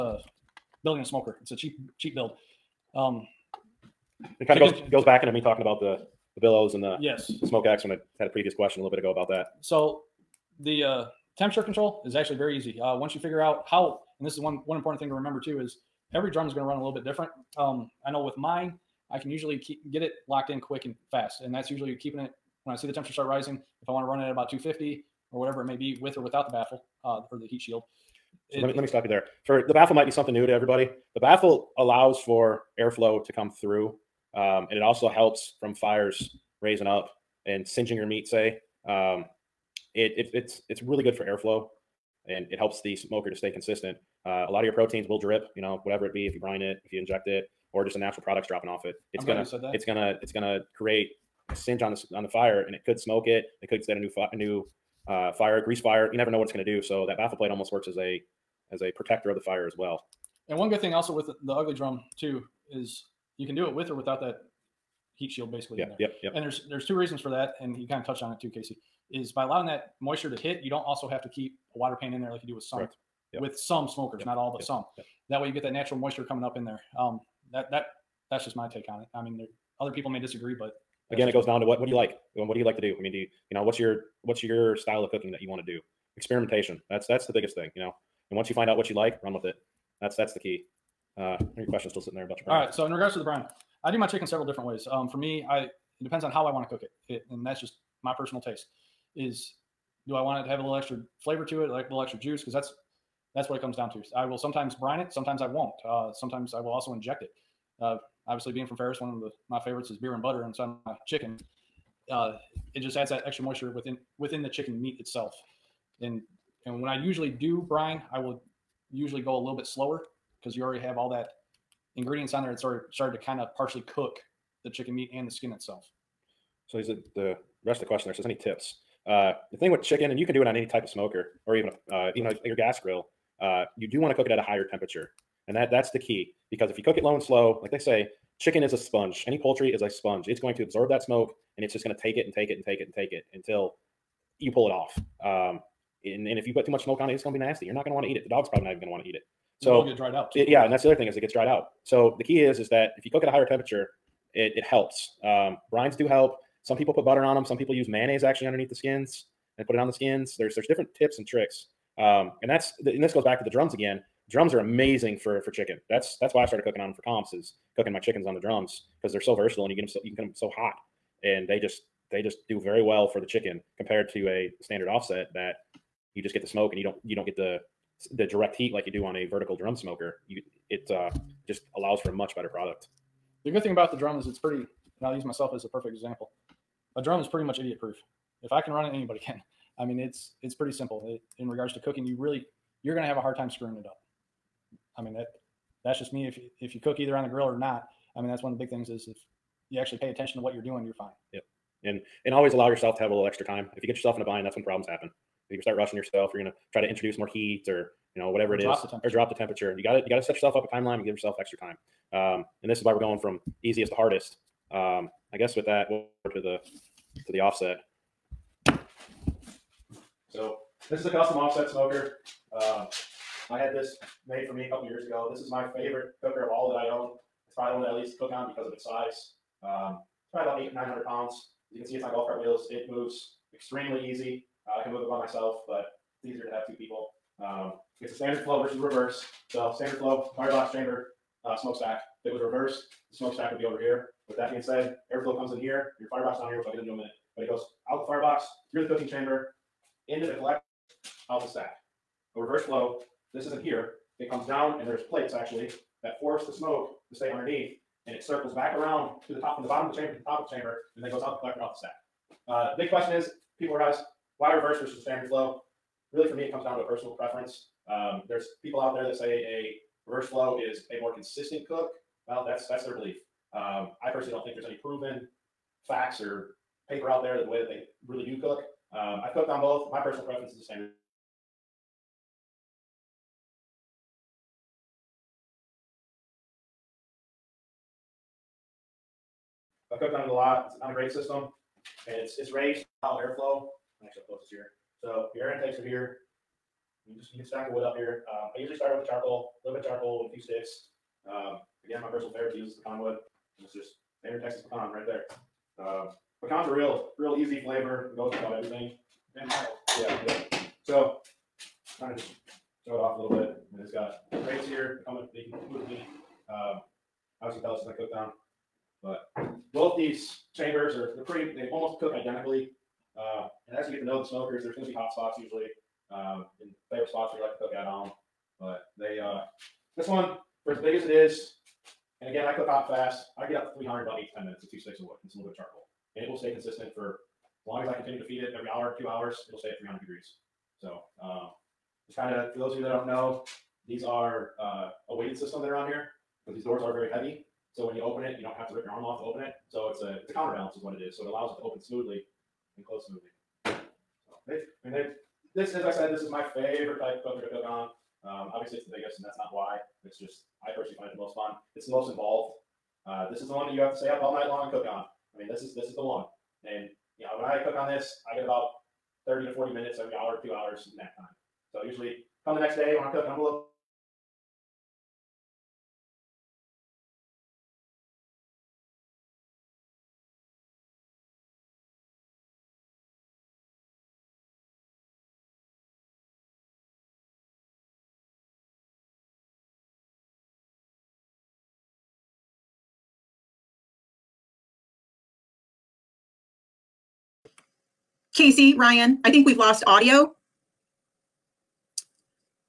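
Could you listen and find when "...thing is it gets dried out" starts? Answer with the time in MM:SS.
02:30.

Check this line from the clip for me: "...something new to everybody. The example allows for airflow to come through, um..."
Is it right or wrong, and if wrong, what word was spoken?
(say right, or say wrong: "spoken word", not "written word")
wrong: "baffle", not "example".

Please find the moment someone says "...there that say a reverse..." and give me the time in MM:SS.
04:28.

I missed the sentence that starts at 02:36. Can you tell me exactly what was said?
Some people put butter on them.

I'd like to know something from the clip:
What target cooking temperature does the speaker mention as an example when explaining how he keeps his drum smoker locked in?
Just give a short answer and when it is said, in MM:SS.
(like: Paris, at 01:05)
250, at 00:24.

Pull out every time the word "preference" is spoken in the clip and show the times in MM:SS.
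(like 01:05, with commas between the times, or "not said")
04:27, 04:40.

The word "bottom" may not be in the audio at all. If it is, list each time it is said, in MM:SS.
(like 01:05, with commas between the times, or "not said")
04:19.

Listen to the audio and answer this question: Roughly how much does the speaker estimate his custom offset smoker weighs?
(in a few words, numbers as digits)
800-900 pounds.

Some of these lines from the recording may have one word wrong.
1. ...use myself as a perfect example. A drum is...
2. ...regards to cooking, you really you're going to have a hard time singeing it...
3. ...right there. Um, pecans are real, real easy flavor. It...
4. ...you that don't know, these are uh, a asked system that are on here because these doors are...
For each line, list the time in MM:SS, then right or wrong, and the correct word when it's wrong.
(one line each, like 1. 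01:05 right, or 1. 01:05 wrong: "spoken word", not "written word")
1. 03:05 right
2. 03:11 wrong: "screwing", not "singeing"
3. 05:04 right
4. 05:42 wrong: "weighted", not "asked".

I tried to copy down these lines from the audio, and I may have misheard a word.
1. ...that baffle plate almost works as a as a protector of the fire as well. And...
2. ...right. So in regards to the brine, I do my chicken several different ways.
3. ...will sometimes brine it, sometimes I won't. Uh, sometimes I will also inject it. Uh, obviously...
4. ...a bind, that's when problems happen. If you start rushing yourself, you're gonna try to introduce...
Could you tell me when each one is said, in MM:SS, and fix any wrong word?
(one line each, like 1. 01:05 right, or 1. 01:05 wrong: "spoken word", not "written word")
1. 00:57 right
2. 01:32 right
3. 01:44 right
4. 03:24 right.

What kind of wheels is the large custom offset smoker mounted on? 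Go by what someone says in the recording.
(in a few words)
golf cart wheels.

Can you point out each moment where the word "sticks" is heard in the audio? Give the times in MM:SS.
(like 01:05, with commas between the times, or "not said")
05:00, 05:34.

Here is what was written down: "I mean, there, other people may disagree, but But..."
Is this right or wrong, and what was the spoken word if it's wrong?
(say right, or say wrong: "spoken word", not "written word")
wrong: "Again", not "But".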